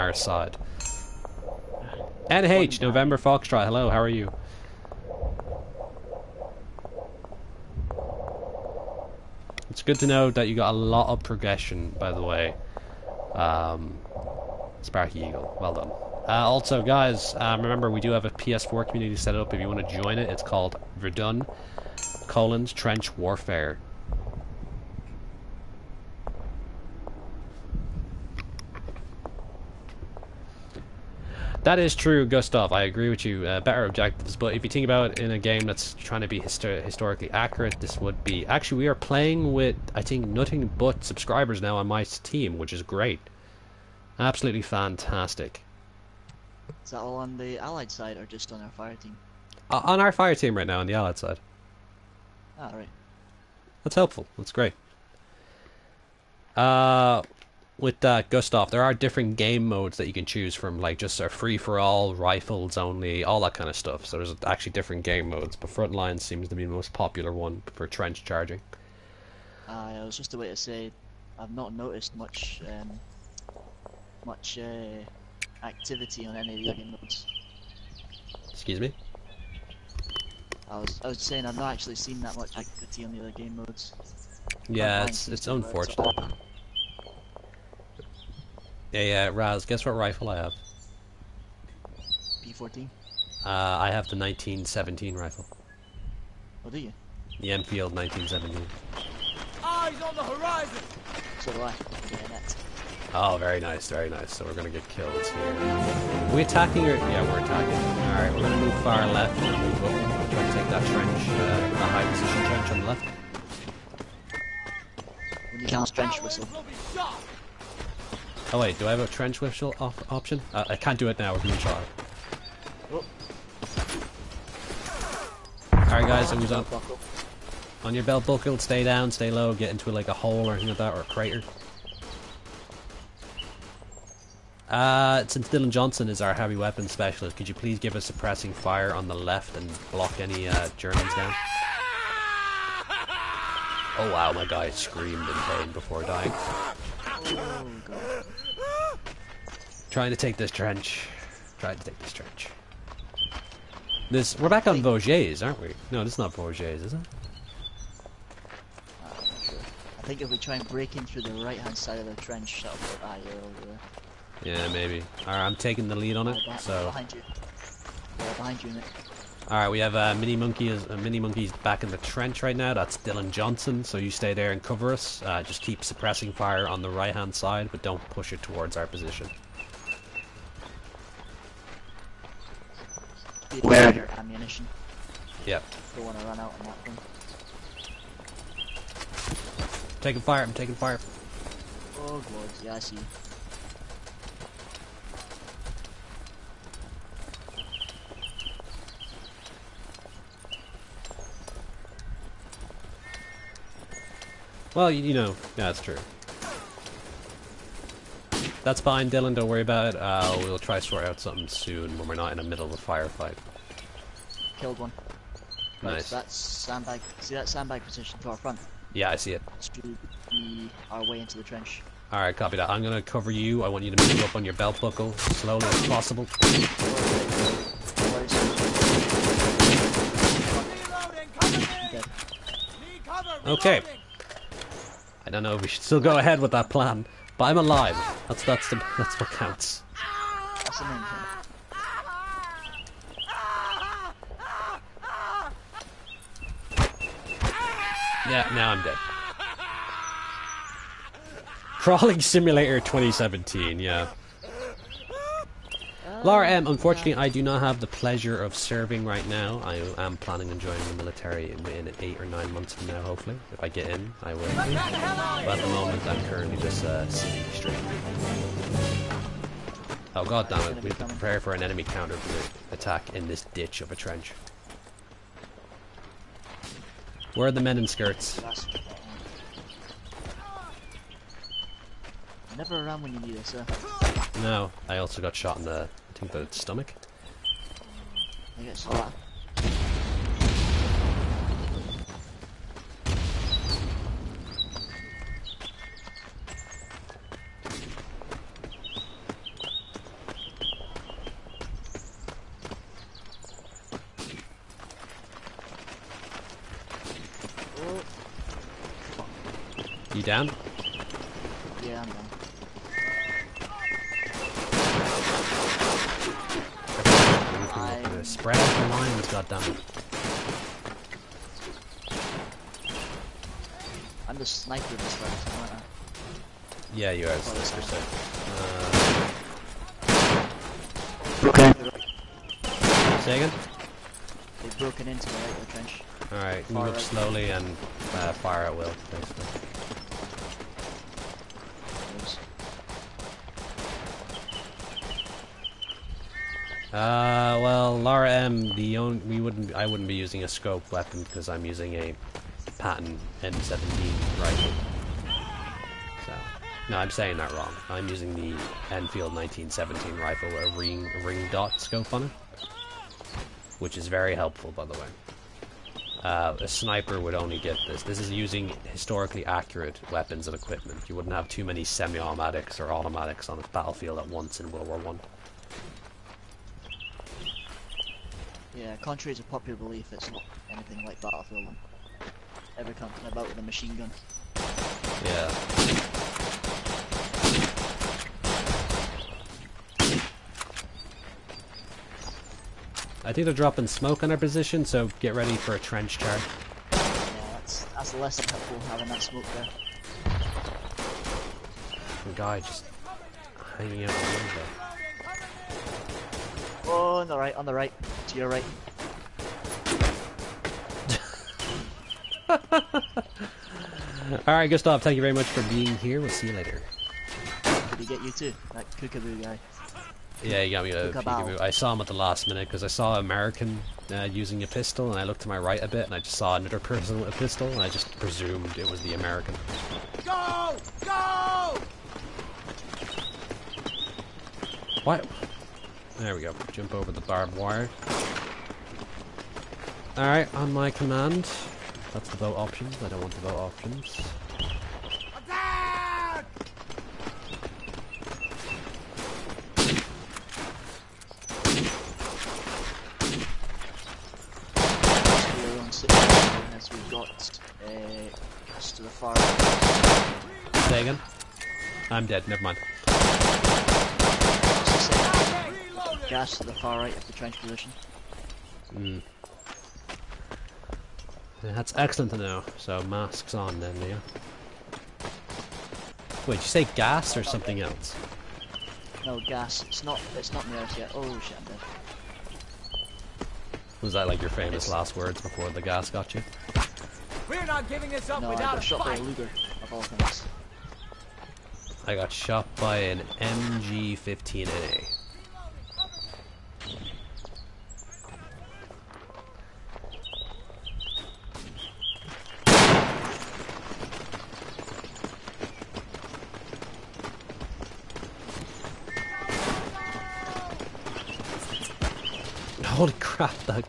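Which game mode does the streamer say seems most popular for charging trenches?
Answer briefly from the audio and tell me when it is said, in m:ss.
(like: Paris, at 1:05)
Frontline, at 1:05.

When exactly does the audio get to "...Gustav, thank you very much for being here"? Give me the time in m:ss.
6:54.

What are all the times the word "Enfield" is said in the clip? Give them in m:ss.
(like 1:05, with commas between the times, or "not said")
1:37, 5:58.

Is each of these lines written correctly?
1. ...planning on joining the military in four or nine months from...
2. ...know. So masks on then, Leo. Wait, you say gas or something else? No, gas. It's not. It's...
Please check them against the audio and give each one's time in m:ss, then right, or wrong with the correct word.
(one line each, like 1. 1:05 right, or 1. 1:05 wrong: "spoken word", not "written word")
1. 4:20 wrong: "eight", not "four"
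2. 7:52 right.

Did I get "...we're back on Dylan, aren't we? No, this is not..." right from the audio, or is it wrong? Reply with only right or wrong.
wrong.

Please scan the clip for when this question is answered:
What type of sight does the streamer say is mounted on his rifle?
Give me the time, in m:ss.
6:01.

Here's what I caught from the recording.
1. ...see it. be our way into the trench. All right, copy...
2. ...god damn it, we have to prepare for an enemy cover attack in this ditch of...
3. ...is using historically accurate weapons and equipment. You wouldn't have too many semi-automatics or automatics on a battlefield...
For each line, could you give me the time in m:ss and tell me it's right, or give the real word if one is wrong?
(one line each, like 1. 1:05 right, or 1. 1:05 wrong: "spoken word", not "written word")
1. 3:39 right
2. 4:30 wrong: "counter", not "cover"
3. 6:08 right.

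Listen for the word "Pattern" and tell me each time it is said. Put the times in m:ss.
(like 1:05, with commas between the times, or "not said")
5:52.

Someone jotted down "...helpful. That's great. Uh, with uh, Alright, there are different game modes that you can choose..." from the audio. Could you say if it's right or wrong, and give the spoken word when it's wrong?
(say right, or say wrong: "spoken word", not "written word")
wrong: "Gustav", not "Alright".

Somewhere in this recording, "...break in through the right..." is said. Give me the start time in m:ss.
2:40.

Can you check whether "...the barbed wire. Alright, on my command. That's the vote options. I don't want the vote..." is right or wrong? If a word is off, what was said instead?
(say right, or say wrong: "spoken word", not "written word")
right.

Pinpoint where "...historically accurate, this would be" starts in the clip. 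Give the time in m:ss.
0:36.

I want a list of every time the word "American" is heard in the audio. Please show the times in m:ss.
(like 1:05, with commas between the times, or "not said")
7:03, 7:09.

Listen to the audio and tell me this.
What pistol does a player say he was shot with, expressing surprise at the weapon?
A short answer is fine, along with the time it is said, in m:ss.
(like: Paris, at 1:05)
Luger, at 8:09.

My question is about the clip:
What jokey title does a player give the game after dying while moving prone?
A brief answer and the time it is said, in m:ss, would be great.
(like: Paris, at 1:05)
Crawling Simulator 2017, at 4:11.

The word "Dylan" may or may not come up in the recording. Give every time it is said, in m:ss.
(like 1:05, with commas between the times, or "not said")
2:15, 2:52, 3:29.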